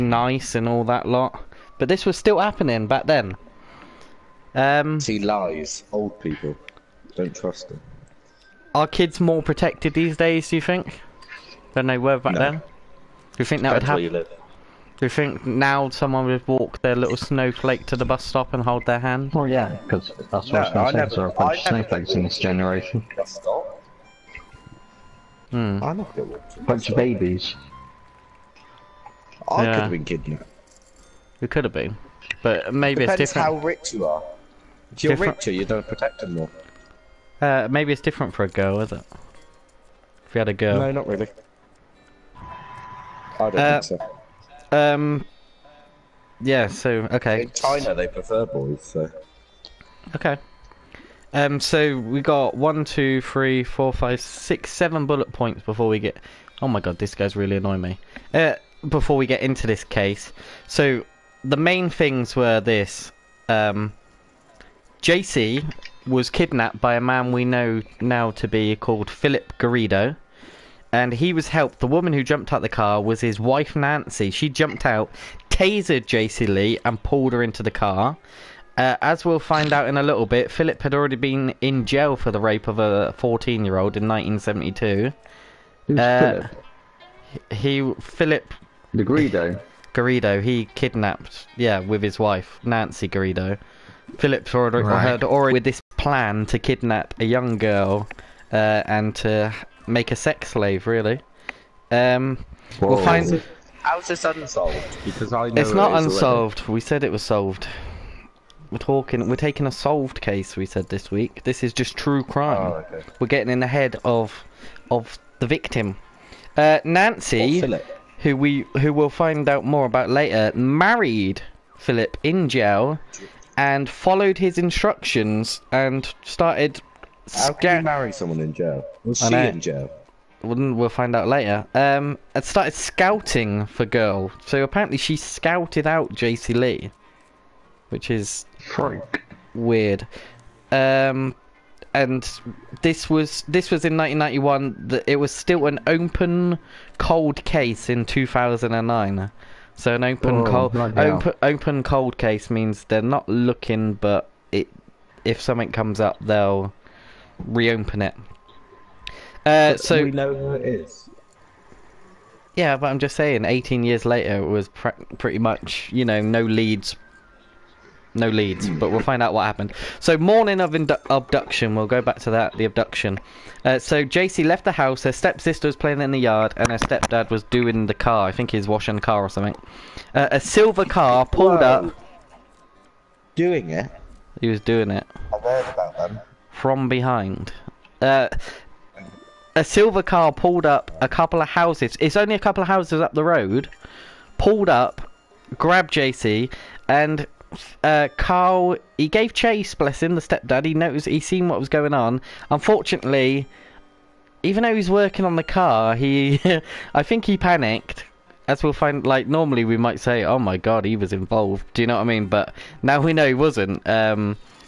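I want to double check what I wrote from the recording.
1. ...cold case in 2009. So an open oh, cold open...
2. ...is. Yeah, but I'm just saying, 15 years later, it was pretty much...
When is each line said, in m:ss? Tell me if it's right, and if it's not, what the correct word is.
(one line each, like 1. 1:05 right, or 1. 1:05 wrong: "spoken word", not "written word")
1. 2:26 right
2. 2:40 wrong: "18", not "15".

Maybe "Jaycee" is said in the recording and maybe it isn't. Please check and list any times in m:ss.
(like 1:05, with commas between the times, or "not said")
1:05, 1:16, 2:16, 2:54, 3:15.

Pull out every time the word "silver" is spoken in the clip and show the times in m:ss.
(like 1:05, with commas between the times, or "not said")
3:00, 3:09.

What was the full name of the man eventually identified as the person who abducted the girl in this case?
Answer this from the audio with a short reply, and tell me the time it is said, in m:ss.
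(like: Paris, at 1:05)
Philip Garrido, at 1:09.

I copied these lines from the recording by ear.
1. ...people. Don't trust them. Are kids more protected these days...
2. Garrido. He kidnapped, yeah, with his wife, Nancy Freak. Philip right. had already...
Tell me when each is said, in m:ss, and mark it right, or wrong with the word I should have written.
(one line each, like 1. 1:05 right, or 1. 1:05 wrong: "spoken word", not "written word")
1. 0:06 right
2. 1:29 wrong: "Garrido", not "Freak".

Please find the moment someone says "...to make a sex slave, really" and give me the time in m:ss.
1:39.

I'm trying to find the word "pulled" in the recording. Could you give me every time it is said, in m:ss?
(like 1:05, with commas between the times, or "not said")
1:17, 3:01, 3:10, 3:14.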